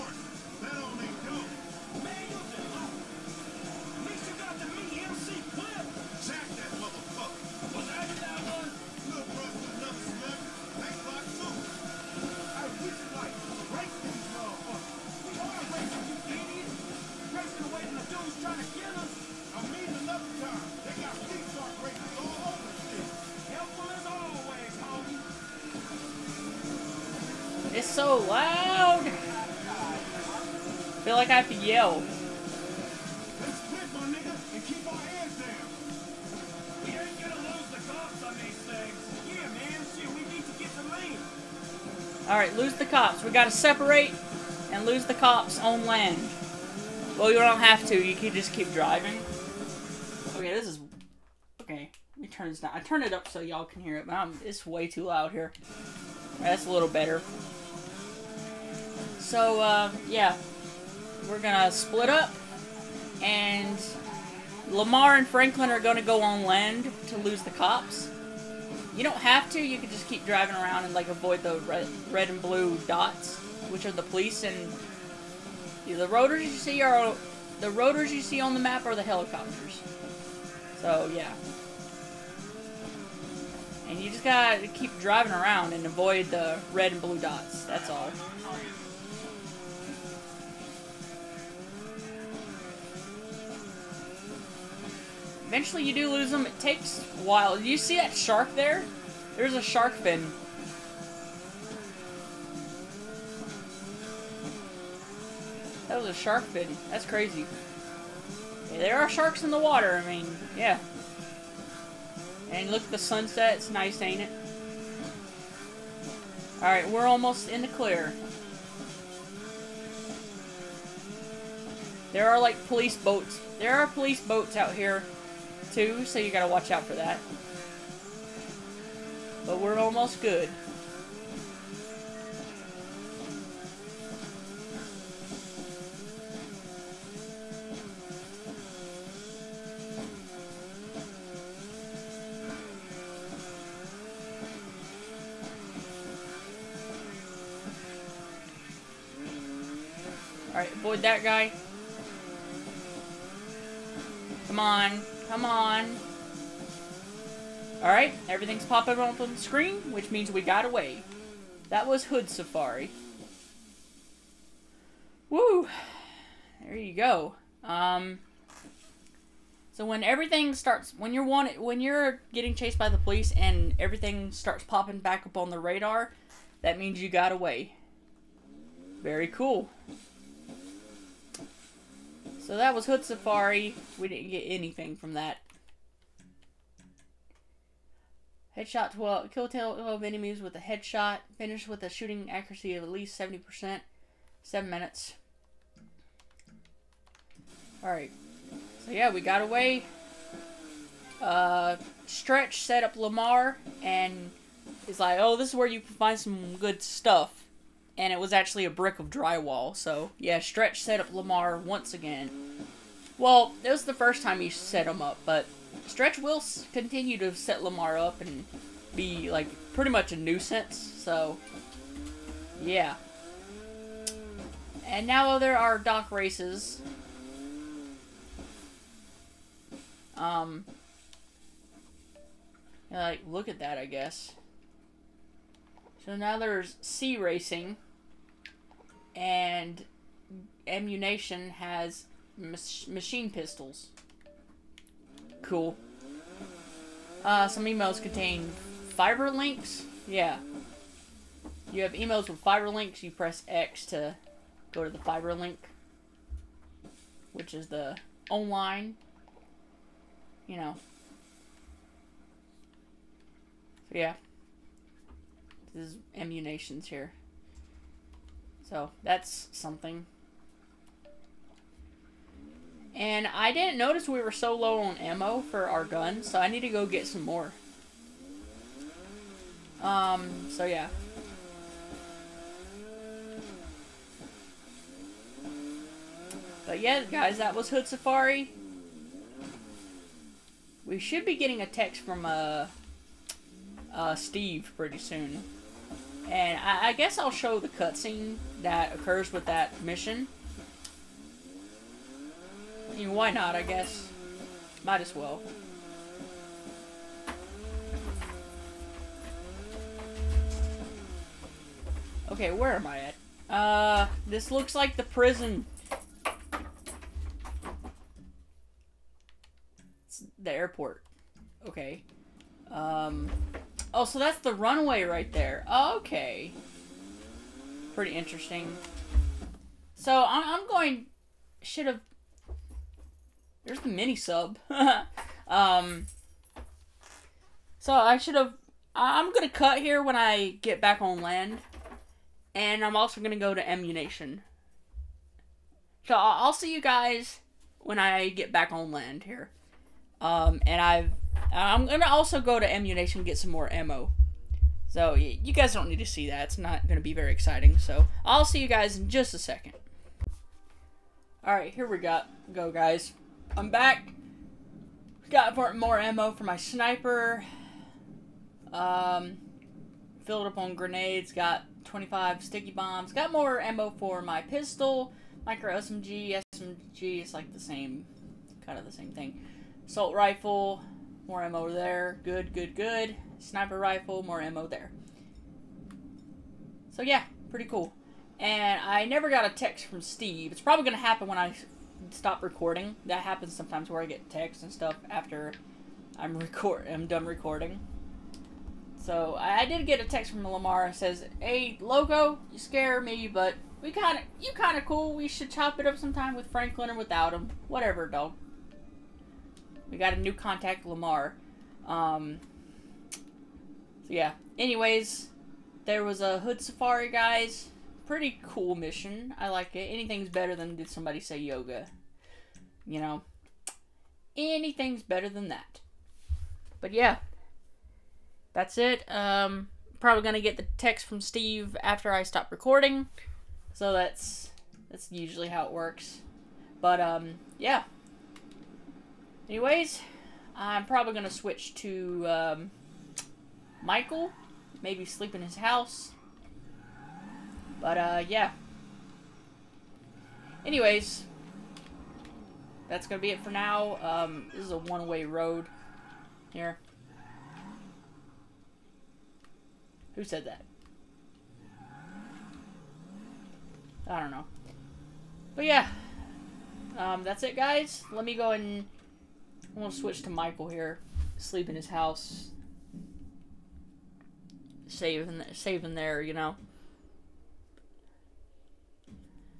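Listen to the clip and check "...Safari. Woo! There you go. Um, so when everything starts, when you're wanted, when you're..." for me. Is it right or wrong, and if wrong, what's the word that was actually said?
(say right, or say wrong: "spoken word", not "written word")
right.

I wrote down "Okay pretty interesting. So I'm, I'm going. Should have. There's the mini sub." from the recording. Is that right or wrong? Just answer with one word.
right.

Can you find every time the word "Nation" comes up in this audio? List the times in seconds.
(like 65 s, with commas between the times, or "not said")
240 s, 343 s, 352 s.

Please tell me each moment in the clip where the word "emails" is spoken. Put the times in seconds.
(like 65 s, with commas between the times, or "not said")
247 s, 251 s.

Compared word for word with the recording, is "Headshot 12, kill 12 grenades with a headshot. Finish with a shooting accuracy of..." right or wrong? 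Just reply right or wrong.
wrong.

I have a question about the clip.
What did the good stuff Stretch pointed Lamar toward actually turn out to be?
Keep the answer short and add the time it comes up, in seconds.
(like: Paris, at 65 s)
A brick of drywall, at 208 s.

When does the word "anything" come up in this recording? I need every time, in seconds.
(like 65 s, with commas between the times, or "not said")
184 s, 419 s, 424 s.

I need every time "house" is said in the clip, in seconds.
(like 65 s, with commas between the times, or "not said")
445 s, 471 s.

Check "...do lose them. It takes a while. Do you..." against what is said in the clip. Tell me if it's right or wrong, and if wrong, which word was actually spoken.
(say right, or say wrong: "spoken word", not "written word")
right.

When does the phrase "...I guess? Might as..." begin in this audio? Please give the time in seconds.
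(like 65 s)
303 s.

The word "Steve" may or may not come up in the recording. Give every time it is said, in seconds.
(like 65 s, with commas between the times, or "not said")
294 s, 390 s, 431 s.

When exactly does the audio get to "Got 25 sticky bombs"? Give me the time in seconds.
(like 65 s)
371 s.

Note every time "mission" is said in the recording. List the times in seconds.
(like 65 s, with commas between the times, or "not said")
299 s, 418 s.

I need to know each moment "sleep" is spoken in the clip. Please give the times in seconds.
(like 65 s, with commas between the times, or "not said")
445 s, 471 s.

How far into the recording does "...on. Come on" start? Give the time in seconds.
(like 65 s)
154 s.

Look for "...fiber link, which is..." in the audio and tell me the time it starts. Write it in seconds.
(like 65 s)
254 s.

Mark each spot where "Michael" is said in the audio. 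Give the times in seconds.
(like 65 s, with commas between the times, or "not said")
443 s, 470 s.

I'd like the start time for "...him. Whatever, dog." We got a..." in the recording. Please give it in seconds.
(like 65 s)
407 s.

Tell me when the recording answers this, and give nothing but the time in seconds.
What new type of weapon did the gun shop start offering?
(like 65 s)
242 s.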